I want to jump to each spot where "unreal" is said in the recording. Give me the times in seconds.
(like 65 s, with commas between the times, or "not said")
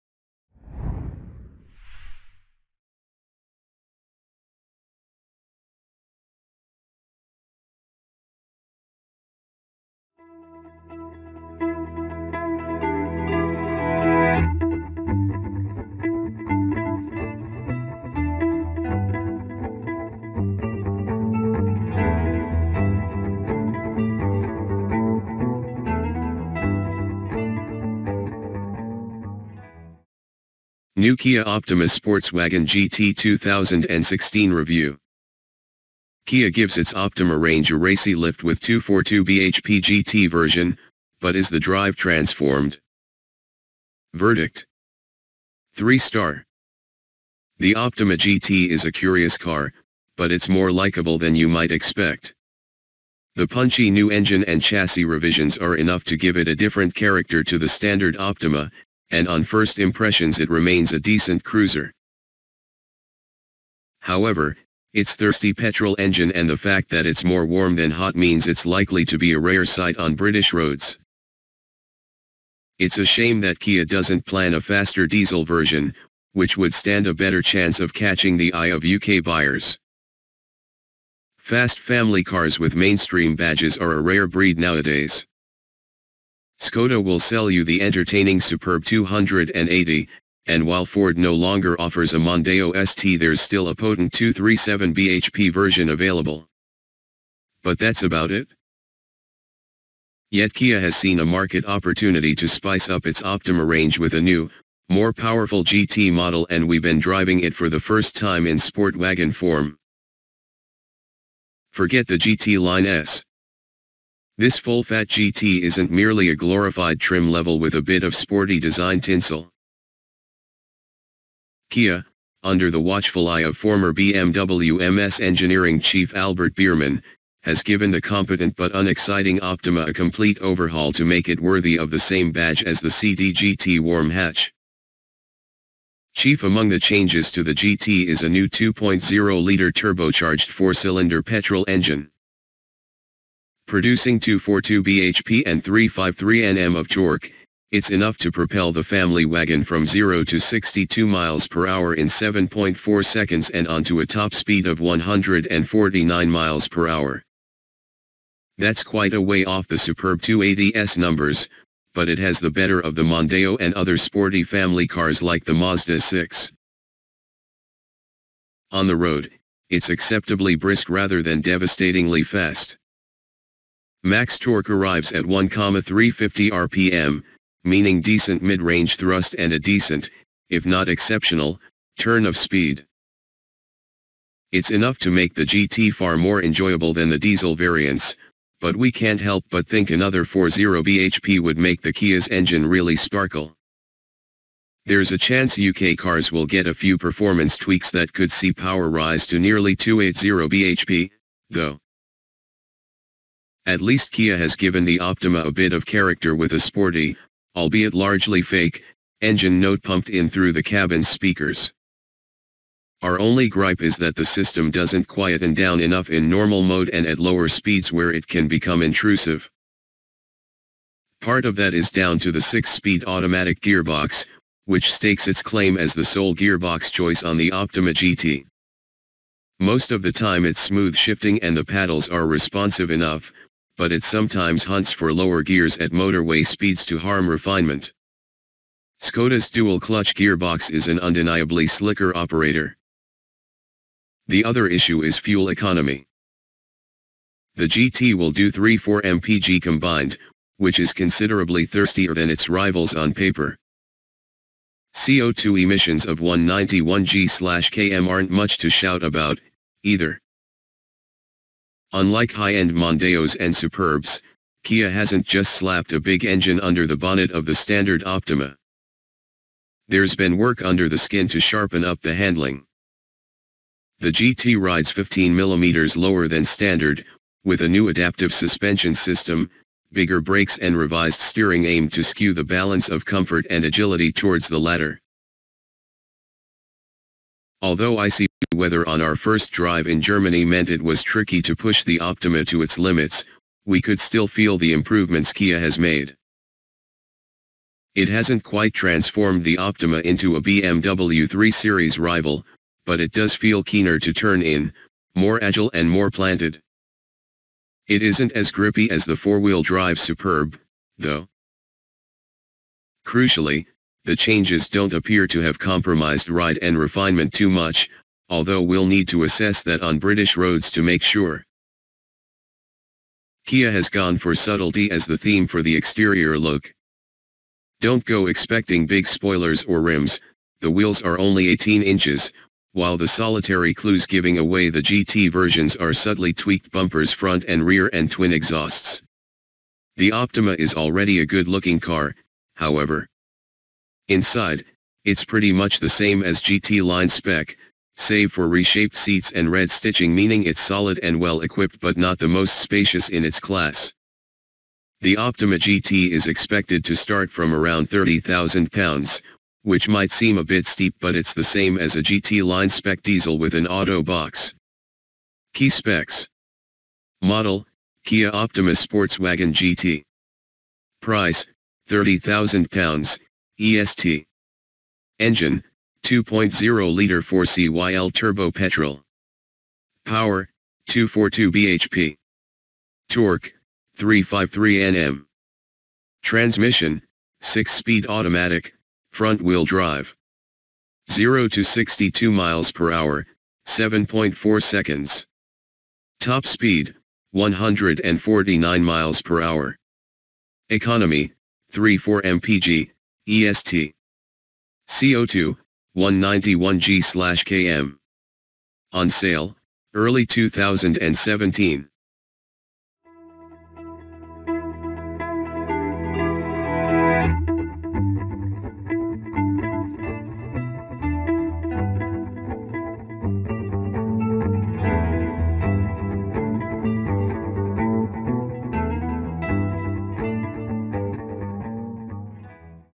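not said.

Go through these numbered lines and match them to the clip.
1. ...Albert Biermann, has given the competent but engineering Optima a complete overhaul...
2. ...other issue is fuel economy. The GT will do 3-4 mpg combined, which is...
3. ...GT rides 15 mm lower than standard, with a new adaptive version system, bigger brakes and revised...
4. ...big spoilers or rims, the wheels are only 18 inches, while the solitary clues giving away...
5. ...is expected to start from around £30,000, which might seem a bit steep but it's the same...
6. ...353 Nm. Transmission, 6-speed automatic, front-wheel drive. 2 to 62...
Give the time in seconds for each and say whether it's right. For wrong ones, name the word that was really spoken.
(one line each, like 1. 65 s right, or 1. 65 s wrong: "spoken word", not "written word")
1. 126 s wrong: "unexciting", not "engineering"
2. 244 s right
3. 274 s wrong: "suspension", not "version"
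4. 328 s right
5. 356 s right
6. 383 s wrong: "0", not "2".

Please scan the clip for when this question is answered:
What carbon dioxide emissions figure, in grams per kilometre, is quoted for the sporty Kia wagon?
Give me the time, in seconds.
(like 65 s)
256 s.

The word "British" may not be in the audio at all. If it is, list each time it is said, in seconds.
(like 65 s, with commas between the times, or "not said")
70 s, 319 s.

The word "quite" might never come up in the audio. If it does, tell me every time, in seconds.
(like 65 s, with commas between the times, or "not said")
158 s, 298 s.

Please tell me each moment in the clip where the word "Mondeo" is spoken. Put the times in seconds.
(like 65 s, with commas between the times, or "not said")
92 s, 163 s, 262 s.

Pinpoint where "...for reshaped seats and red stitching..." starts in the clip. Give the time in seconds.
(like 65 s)
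348 s.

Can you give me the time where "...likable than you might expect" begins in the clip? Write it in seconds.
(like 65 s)
50 s.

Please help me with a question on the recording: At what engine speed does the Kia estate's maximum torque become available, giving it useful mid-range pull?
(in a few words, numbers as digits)
1,350 rpm.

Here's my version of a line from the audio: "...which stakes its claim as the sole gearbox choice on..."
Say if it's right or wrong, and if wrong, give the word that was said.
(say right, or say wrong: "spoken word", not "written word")
right.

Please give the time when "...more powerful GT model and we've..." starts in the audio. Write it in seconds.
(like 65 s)
104 s.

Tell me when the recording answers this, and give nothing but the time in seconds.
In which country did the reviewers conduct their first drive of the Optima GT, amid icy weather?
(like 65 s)
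290 s.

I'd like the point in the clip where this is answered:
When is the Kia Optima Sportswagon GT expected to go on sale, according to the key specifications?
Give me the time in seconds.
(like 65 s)
409 s.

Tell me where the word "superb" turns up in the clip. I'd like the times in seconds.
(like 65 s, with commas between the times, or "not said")
88 s, 159 s, 263 s, 309 s.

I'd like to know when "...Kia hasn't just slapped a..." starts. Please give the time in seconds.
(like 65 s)
264 s.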